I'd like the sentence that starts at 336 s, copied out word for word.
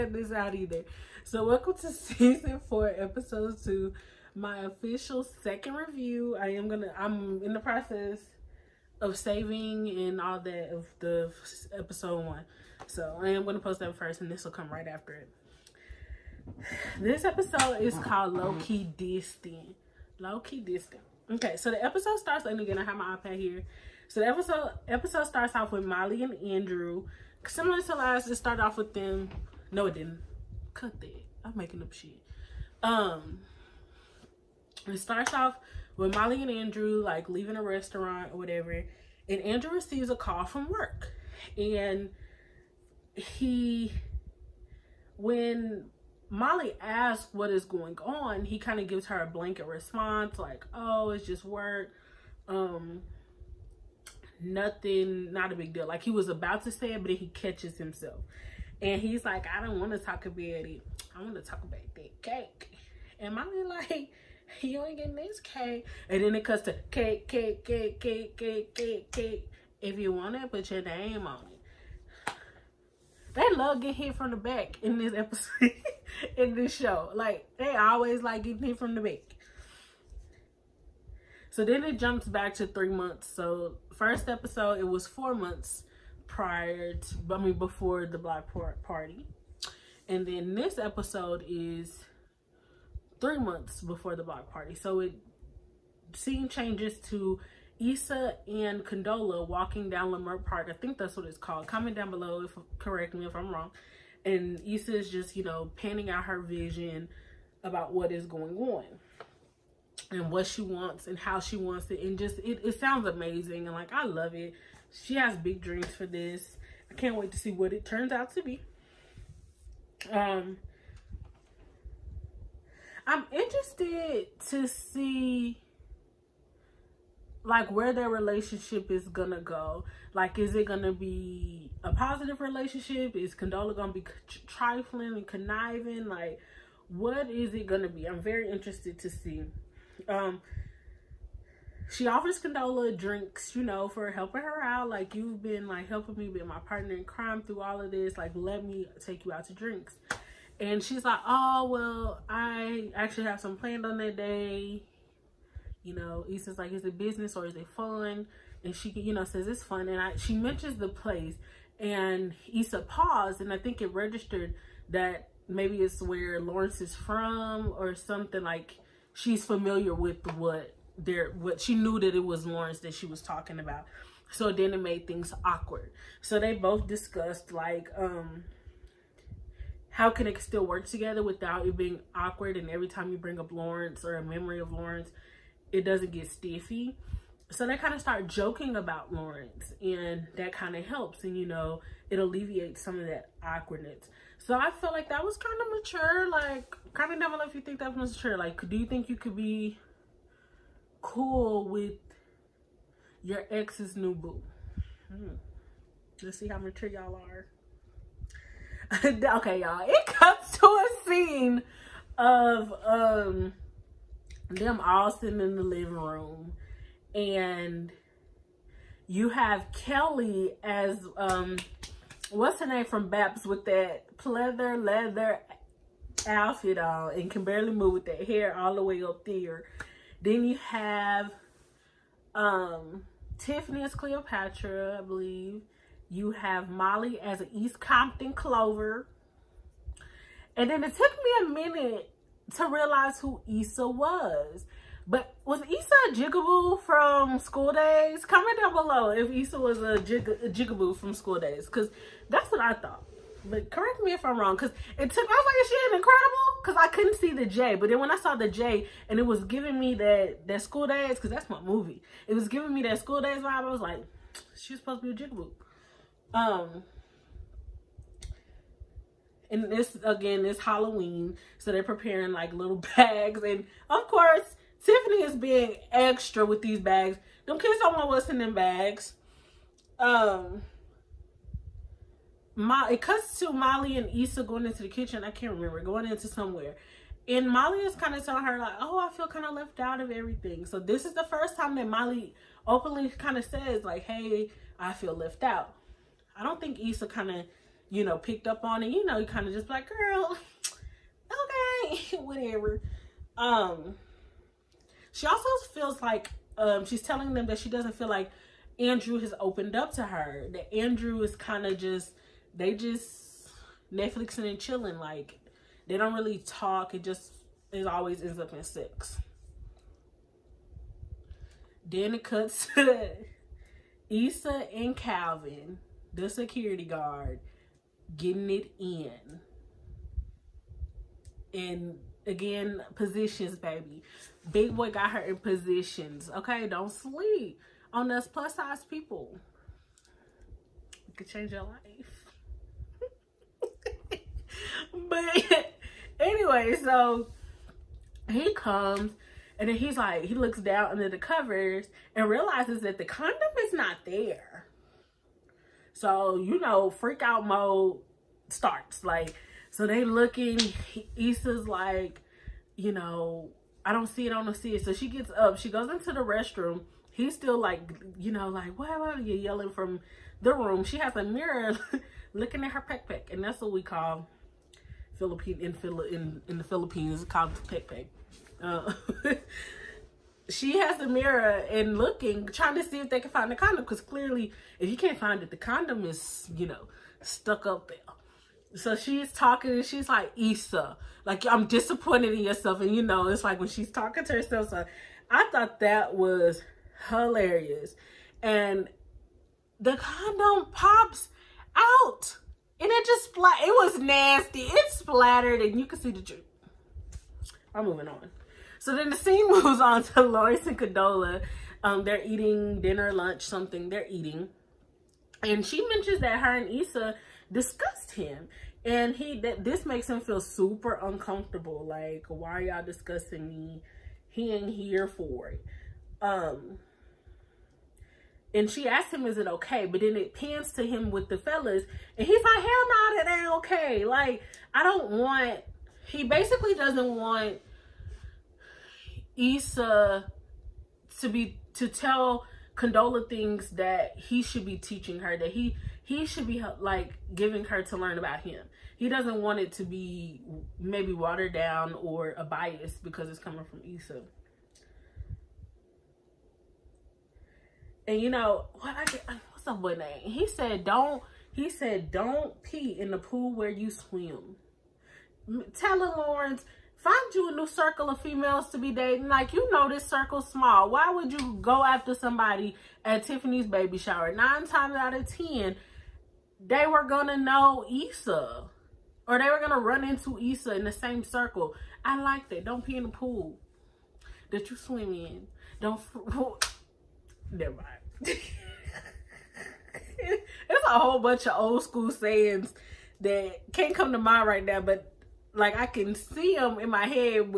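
Okay, don't sleep on us plus size people.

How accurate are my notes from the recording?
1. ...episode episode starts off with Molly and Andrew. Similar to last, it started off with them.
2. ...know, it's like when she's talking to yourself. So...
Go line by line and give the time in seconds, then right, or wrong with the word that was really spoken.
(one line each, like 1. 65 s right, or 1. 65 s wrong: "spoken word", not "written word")
1. 24 s right
2. 393 s wrong: "herself", not "yourself".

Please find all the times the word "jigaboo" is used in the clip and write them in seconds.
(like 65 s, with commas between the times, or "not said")
246 s, 250 s, 265 s.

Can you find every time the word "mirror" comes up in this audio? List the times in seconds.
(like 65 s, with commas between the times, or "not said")
371 s, 381 s.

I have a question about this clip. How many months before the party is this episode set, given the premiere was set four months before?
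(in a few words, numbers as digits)
3.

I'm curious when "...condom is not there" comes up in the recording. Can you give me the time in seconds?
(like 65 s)
353 s.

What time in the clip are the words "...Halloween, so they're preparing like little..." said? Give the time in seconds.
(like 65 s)
270 s.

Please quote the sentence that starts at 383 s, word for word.
Because clearly, if you can't find it, the condom is, you know, stuck up there.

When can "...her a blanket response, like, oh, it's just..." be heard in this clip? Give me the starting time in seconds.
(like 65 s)
49 s.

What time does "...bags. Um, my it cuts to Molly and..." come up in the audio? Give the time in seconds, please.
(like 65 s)
278 s.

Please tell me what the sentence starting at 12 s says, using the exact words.
So, I am gonna post that first, and this will come right after it this episode is called Low Key Distant.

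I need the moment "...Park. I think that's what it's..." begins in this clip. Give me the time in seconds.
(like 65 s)
100 s.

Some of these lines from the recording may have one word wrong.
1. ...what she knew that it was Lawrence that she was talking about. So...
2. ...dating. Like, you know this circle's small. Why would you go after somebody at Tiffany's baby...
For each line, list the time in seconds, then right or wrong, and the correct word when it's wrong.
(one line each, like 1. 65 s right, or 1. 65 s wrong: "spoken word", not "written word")
1. 171 s right
2. 468 s right.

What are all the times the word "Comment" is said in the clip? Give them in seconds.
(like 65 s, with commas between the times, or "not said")
101 s, 248 s.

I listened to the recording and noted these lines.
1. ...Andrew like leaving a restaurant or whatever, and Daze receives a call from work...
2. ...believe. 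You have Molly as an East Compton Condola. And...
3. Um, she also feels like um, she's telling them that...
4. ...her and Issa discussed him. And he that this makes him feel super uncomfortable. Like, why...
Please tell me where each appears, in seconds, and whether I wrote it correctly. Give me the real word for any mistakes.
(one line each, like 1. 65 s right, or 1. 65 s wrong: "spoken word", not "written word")
1. 36 s wrong: "Andrew", not "Daze"
2. 235 s wrong: "Clover", not "Condola"
3. 303 s right
4. 416 s right.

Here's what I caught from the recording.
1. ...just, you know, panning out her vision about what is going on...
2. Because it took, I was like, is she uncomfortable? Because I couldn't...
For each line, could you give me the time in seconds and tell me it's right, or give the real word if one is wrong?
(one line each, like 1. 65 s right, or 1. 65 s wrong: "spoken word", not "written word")
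1. 105 s right
2. 254 s wrong: "incredible", not "uncomfortable".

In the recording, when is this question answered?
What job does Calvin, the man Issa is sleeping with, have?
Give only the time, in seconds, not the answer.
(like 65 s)
326 s.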